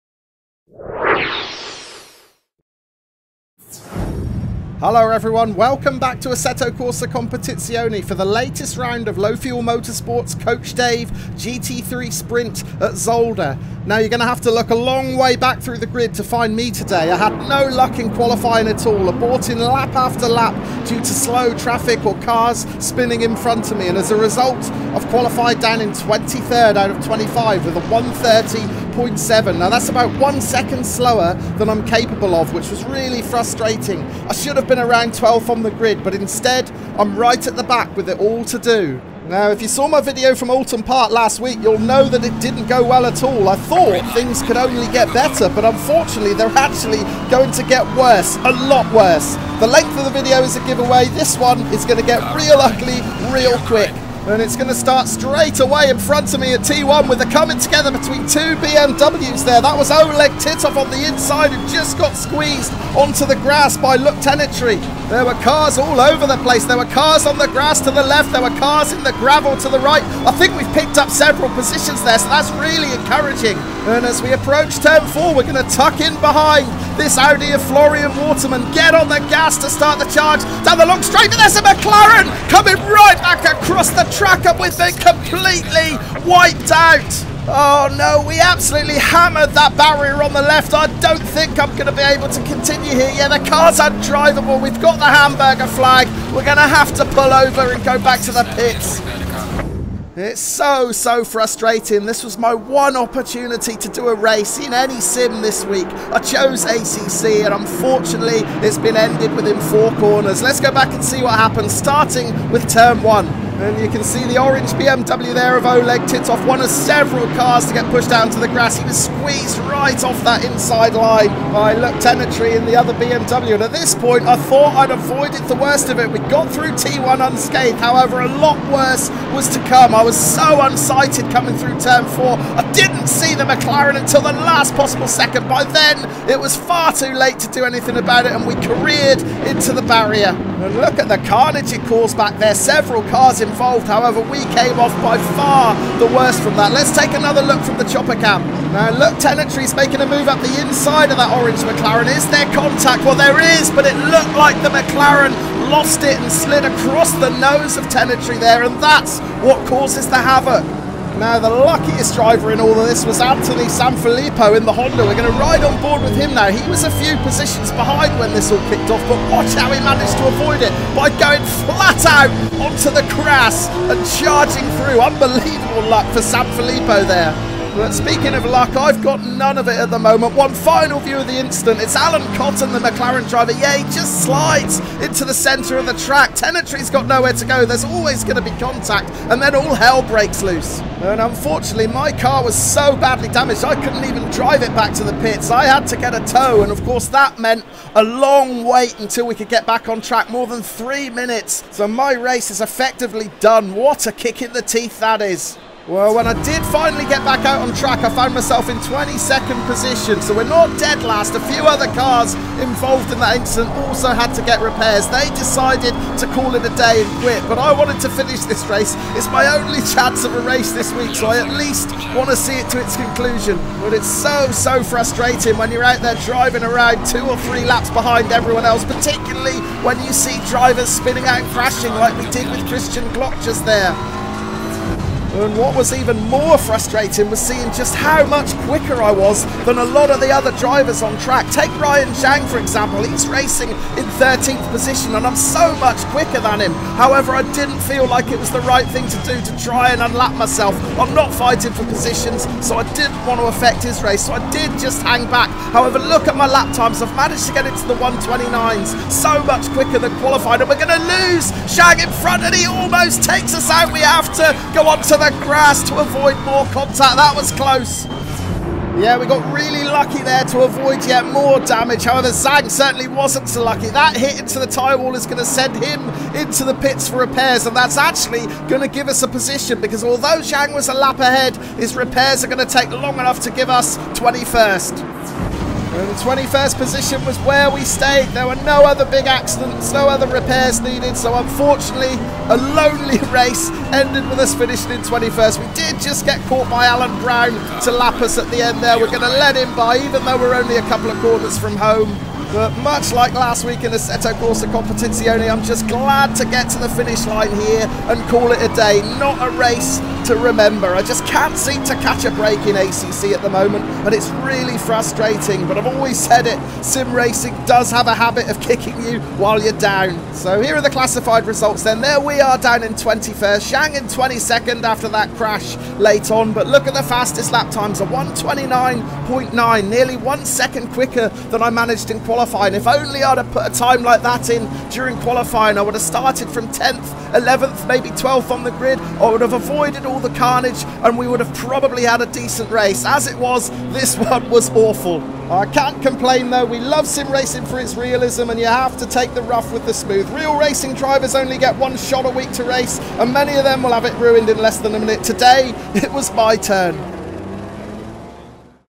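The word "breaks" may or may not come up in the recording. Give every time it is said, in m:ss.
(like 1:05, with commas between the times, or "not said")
3:10, 5:12.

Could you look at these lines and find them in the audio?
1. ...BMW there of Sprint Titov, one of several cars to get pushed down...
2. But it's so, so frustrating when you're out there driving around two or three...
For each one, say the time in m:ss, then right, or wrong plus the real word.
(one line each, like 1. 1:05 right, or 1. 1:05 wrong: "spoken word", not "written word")
1. 1:54 wrong: "Oleg", not "Sprint"
2. 3:43 right.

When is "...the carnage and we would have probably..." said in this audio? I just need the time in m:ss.
5:40.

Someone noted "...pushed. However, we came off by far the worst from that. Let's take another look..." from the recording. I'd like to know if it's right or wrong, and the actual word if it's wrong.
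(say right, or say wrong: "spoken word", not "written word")
wrong: "involved", not "pushed".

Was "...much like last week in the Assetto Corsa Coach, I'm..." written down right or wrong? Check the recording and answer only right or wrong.
wrong.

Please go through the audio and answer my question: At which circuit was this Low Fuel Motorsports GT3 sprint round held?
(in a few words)
Zolder.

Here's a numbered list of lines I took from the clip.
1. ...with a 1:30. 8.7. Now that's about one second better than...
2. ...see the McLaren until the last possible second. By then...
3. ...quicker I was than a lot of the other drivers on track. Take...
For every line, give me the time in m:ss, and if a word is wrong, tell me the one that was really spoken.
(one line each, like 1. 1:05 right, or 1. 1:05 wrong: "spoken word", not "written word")
1. 0:27 wrong: "slower", not "better"
2. 2:13 right
3. 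3:58 right.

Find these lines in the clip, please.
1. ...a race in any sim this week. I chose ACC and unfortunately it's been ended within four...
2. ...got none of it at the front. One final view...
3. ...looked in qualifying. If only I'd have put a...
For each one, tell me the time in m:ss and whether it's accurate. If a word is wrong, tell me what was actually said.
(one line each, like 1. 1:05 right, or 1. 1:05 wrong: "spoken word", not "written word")
1. 1:44 right
2. 2:59 wrong: "moment", not "front"
3. 5:31 wrong: "managed", not "looked".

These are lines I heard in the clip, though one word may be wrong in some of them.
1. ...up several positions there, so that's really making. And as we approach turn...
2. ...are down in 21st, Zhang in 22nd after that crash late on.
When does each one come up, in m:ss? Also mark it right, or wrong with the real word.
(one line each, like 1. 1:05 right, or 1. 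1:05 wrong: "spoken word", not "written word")
1. 1:10 wrong: "encouraging", not "making"
2. 5:22 right.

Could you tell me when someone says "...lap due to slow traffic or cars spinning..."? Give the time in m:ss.
0:20.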